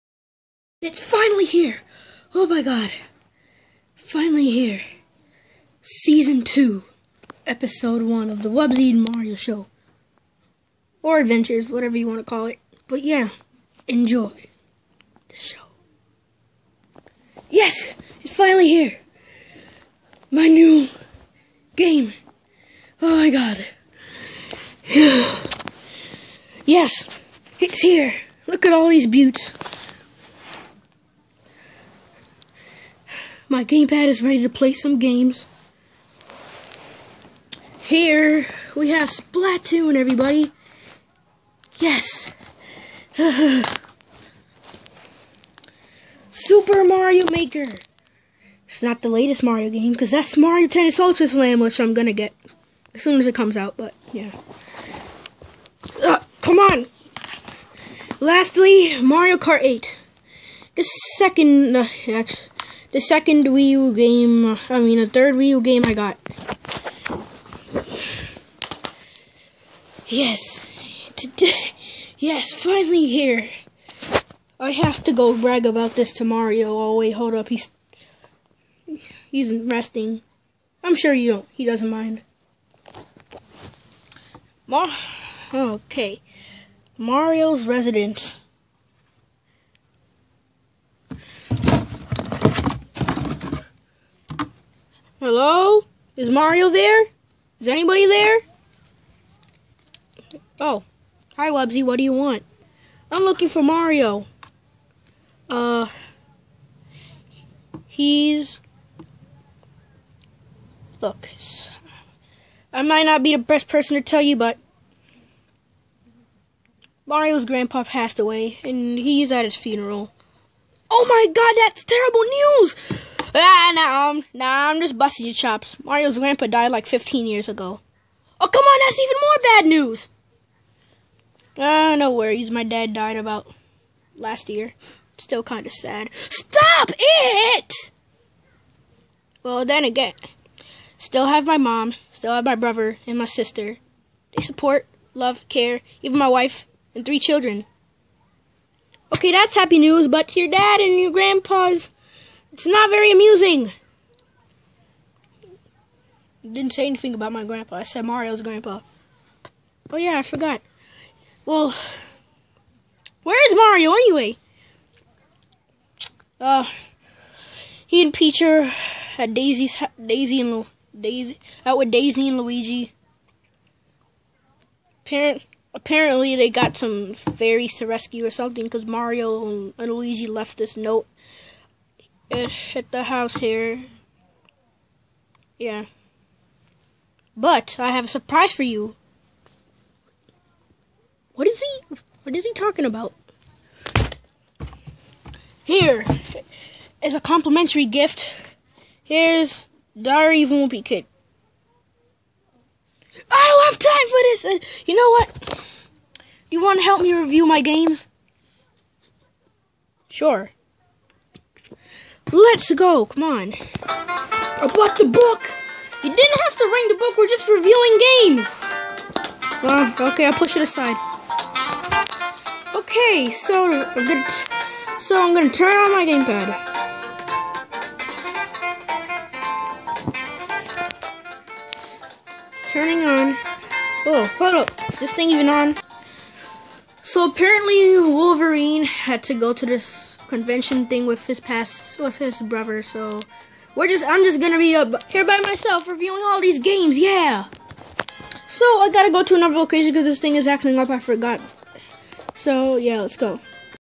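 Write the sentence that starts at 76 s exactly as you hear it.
Oh wait, hold up, he's he's resting.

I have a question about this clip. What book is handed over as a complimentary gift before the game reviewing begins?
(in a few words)
Diary of Wimpy Kid.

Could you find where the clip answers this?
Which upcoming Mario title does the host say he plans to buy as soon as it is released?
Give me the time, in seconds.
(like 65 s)
50 s.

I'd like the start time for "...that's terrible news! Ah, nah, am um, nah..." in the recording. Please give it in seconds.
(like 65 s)
121 s.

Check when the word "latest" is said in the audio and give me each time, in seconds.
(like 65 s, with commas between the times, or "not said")
49 s.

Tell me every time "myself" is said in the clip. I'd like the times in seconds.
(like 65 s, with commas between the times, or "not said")
245 s.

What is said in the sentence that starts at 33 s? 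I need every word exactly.
My gamepad is ready to play some games.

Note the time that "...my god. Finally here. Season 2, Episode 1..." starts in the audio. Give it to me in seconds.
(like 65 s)
2 s.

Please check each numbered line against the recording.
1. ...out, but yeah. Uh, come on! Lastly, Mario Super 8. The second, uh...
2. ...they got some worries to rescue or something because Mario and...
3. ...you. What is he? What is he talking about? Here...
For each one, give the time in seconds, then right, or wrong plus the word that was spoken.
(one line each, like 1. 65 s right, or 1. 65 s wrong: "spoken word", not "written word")
1. 53 s wrong: "Kart", not "Super"
2. 176 s wrong: "fairies", not "worries"
3. 188 s right.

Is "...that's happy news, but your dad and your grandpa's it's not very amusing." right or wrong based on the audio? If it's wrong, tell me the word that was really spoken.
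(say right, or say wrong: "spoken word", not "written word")
right.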